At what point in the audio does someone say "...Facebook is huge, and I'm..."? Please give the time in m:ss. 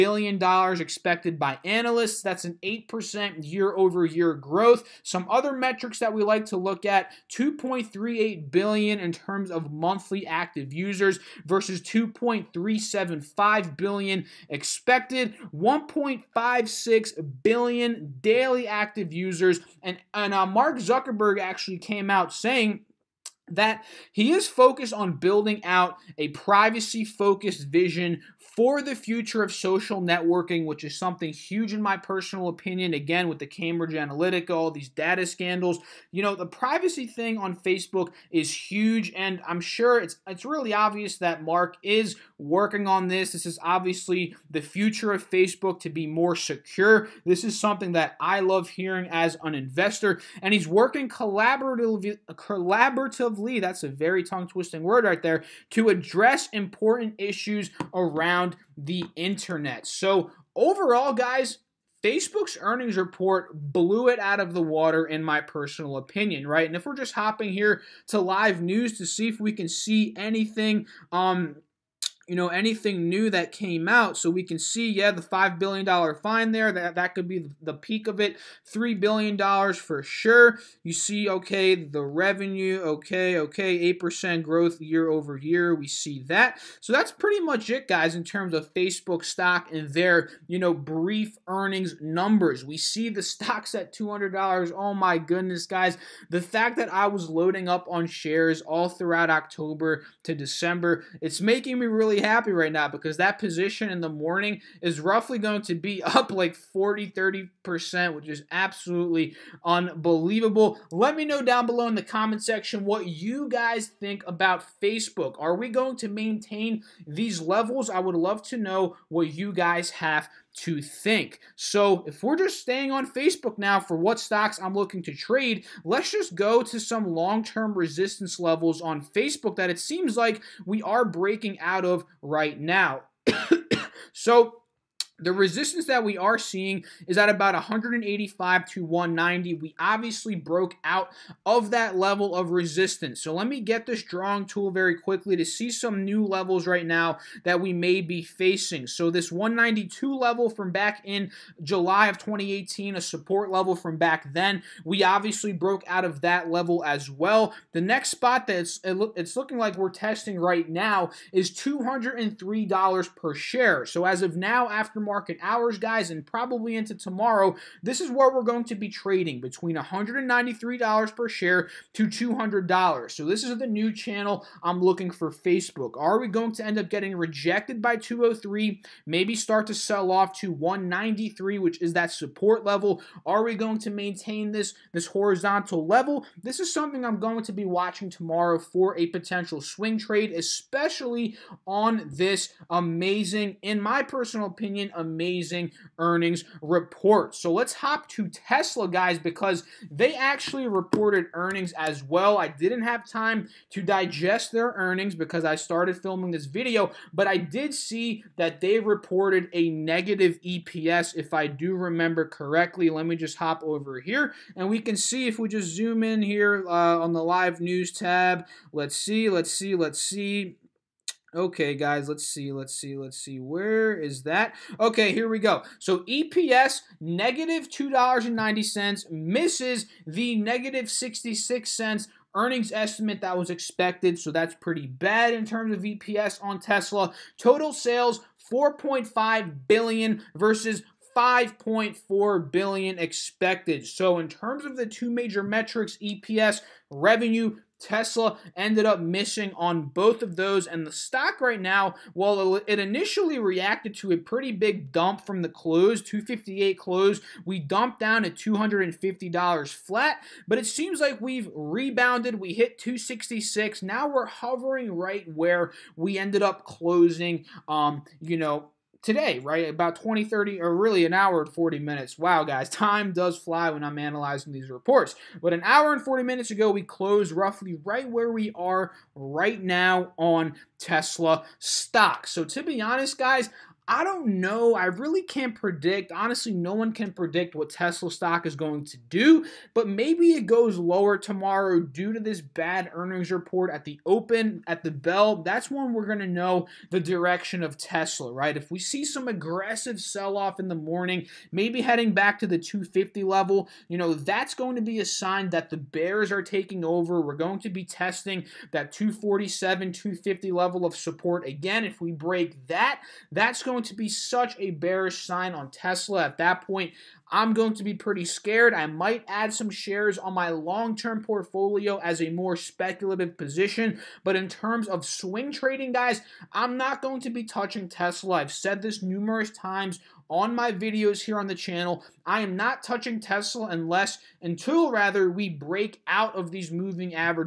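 0:37.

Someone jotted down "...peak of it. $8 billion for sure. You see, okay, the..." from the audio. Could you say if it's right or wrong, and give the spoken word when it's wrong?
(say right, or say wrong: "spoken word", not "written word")
wrong: "3", not "8".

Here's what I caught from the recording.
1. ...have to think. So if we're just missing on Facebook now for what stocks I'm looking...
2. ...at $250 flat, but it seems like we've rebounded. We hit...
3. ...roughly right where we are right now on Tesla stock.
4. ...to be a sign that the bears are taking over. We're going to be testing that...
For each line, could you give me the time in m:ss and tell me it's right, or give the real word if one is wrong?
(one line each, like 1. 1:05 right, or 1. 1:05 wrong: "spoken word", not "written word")
1. 1:59 wrong: "staying", not "missing"
2. 4:18 right
3. 4:37 right
4. 5:04 right.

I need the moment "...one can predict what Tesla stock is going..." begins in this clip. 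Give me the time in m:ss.
4:46.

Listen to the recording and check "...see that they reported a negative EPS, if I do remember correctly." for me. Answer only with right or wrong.
right.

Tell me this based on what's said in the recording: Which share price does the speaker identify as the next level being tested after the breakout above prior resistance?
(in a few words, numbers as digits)
$203.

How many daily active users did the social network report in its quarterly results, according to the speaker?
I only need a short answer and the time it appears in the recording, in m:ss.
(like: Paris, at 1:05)
1.56 billion, at 0:15.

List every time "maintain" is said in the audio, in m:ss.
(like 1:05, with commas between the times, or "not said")
1:56, 3:03.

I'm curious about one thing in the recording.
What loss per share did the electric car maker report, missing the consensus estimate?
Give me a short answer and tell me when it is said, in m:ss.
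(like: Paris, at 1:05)
-$2.90, at 3:46.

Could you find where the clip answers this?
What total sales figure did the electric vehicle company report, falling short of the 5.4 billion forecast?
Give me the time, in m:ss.
3:58.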